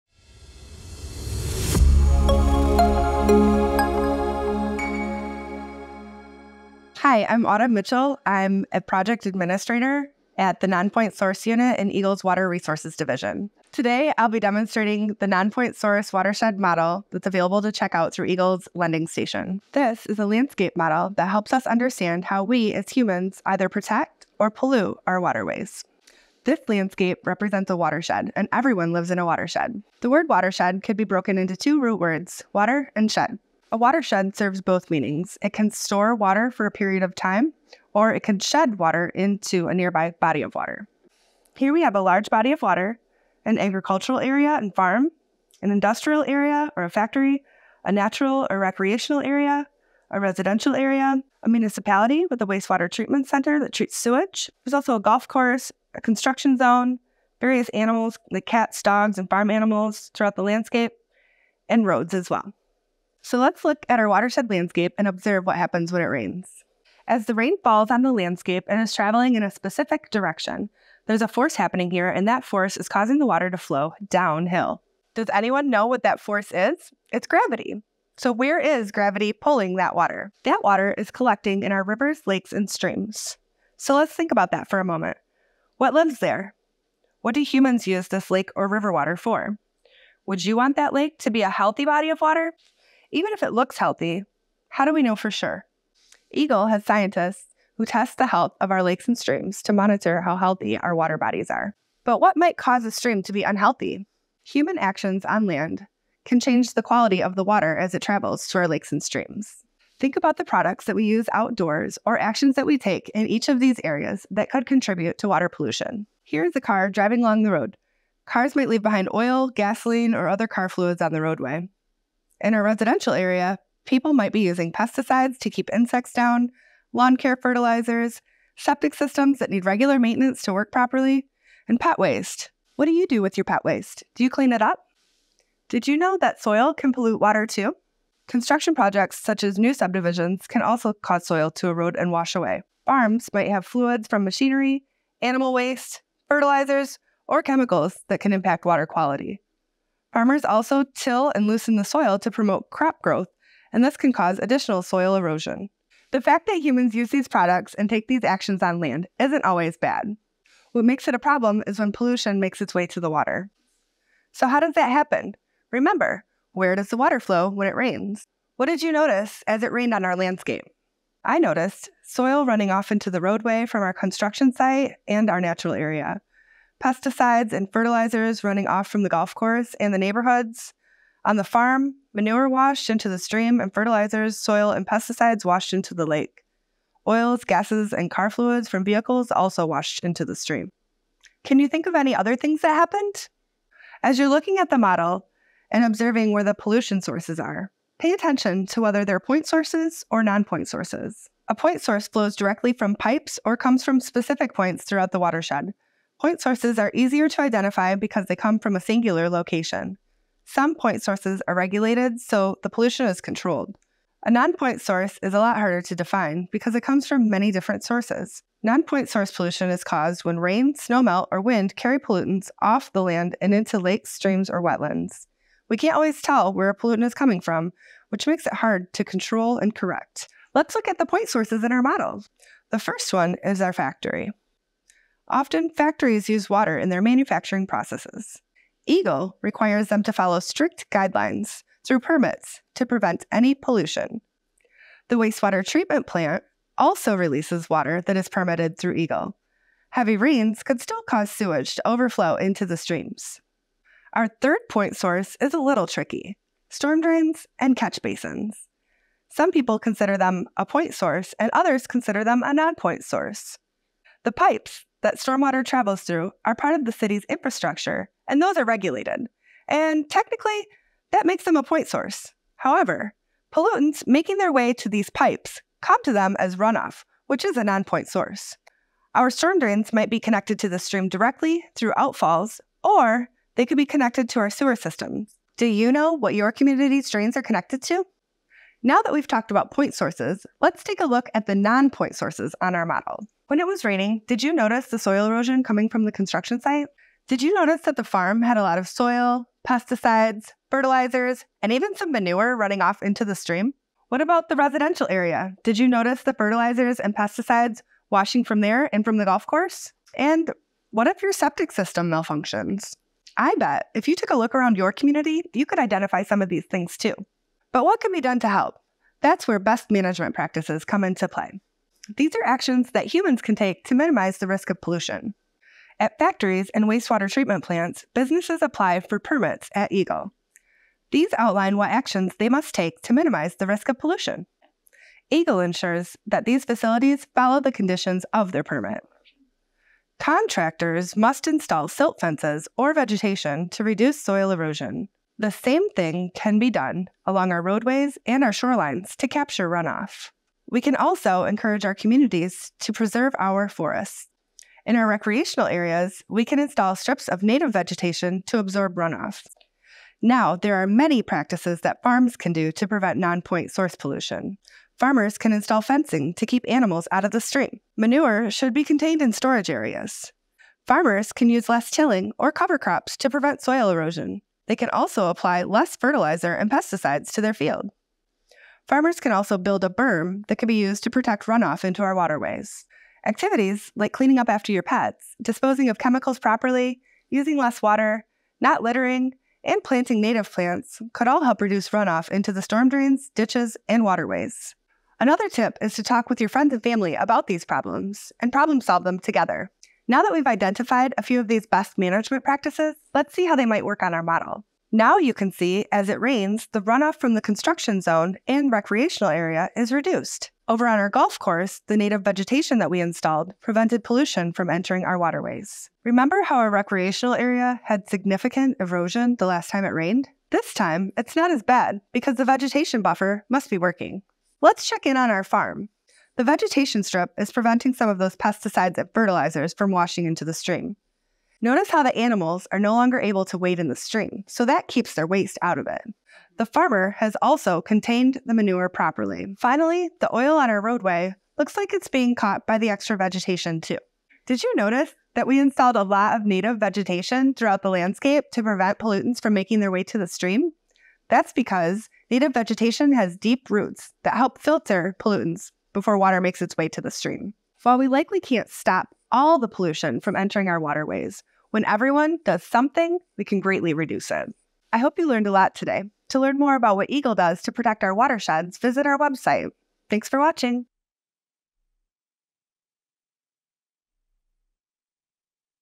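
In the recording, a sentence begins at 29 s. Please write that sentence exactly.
The word watershed could be broken into two root words, water and shed.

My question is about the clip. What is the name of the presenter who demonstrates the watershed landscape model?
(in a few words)
Autumn Mitchell.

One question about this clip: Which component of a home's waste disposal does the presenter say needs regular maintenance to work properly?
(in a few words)
Septic systems.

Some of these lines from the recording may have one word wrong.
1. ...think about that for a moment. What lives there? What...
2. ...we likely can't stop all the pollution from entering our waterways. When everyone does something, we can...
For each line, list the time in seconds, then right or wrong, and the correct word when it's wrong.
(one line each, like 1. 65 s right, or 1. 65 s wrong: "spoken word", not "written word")
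1. 84 s right
2. 457 s right.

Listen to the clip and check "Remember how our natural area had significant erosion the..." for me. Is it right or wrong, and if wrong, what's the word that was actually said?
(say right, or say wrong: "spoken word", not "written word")
wrong: "recreational", not "natural".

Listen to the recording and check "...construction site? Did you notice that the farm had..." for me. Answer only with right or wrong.
right.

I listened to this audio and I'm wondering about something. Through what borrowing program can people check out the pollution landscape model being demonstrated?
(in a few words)
EGLE's Lending Station.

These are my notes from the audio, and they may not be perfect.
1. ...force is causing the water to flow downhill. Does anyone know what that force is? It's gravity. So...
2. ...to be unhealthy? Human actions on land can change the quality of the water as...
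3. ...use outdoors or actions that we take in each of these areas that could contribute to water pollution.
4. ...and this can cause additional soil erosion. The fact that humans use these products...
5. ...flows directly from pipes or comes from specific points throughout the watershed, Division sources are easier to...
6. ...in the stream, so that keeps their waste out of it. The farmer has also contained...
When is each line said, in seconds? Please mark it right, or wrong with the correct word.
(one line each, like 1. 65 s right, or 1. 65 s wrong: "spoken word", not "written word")
1. 72 s right
2. 103 s right
3. 111 s right
4. 153 s right
5. 202 s wrong: "Point", not "Division"
6. 433 s right.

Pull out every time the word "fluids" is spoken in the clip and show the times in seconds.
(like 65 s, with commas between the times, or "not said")
120 s, 143 s, 188 s.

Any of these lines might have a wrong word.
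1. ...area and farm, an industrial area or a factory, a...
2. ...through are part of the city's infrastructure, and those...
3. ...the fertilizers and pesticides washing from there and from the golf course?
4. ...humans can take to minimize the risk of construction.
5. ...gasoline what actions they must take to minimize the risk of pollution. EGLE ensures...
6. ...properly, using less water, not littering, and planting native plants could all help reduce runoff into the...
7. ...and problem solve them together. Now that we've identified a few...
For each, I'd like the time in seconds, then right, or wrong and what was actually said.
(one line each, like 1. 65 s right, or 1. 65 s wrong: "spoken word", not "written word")
1. 44 s right
2. 266 s right
3. 306 s right
4. 323 s wrong: "pollution", not "construction"
5. 331 s wrong: "outline", not "gasoline"
6. 386 s right
7. 398 s right.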